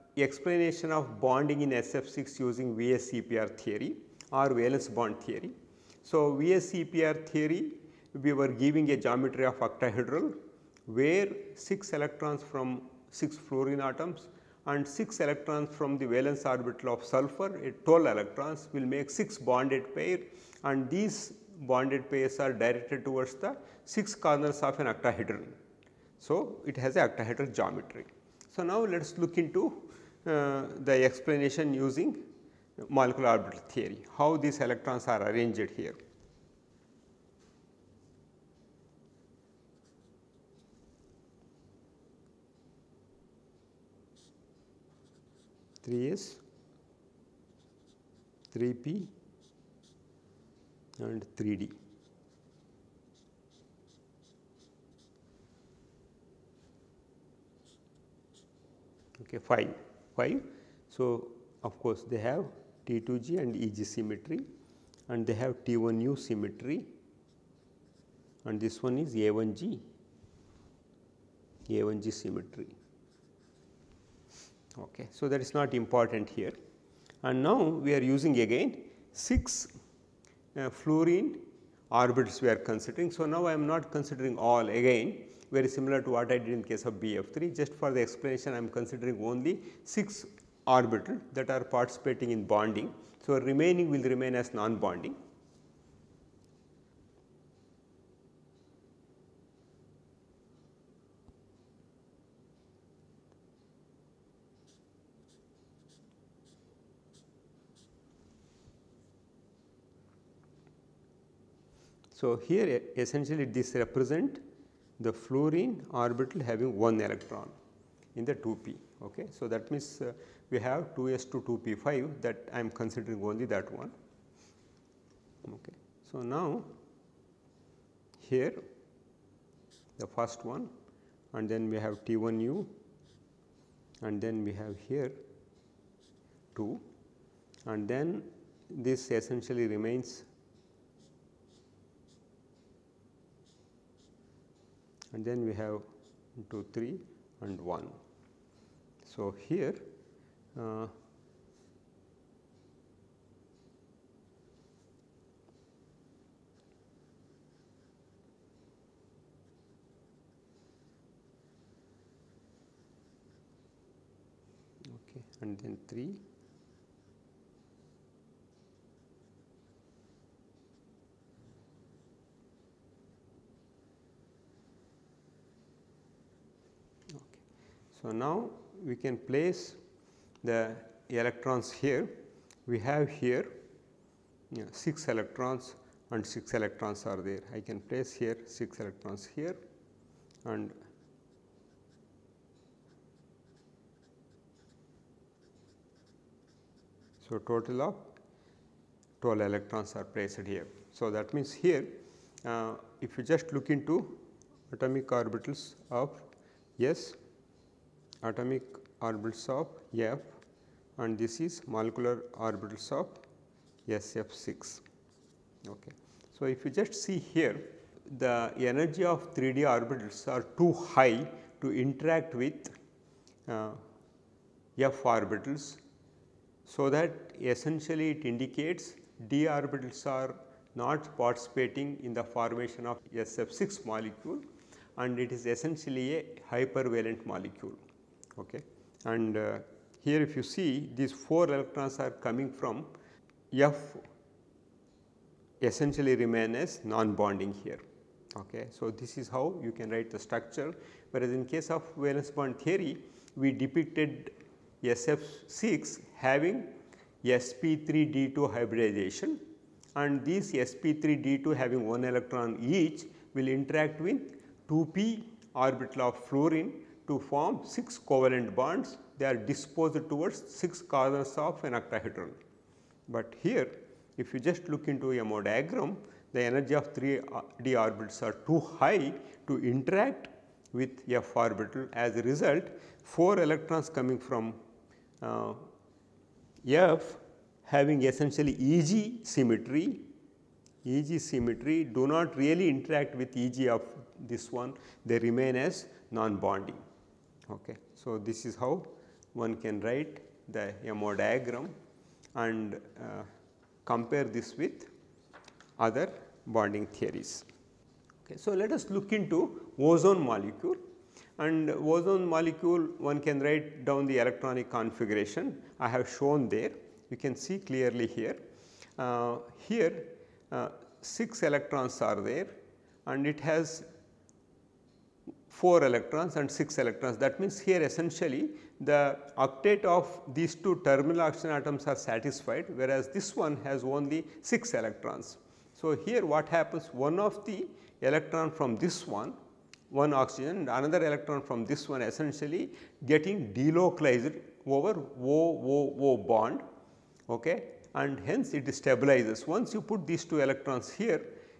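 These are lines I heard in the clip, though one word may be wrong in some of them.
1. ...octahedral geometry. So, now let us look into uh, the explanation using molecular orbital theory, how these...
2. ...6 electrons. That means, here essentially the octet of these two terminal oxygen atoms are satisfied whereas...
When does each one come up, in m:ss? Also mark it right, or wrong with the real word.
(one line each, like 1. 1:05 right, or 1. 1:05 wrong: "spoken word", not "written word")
1. 0:27 right
2. 5:26 right.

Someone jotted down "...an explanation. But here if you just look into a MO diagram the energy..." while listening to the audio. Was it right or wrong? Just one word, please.
wrong.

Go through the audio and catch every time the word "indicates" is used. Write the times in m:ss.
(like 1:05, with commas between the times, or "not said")
3:48.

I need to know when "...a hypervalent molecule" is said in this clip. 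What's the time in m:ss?
3:56.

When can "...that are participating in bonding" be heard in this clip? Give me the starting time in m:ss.
1:31.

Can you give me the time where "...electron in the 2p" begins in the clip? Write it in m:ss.
1:56.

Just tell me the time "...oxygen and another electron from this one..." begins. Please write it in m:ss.
5:40.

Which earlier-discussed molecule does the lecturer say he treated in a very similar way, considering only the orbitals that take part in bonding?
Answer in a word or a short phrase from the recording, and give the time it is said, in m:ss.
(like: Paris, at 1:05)
BF3, at 1:26.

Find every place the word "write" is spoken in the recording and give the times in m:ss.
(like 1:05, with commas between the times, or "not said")
4:09, 4:59, 5:13.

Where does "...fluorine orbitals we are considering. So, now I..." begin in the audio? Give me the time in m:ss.
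1:20.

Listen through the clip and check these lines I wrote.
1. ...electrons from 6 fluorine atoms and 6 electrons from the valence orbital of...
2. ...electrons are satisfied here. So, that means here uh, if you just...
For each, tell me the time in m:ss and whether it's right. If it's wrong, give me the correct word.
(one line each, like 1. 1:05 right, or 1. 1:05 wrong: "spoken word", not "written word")
1. 0:11 right
2. 3:19 wrong: "placed", not "satisfied".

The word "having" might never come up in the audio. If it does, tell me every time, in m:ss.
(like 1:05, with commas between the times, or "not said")
1:56, 4:16, 4:21, 4:47.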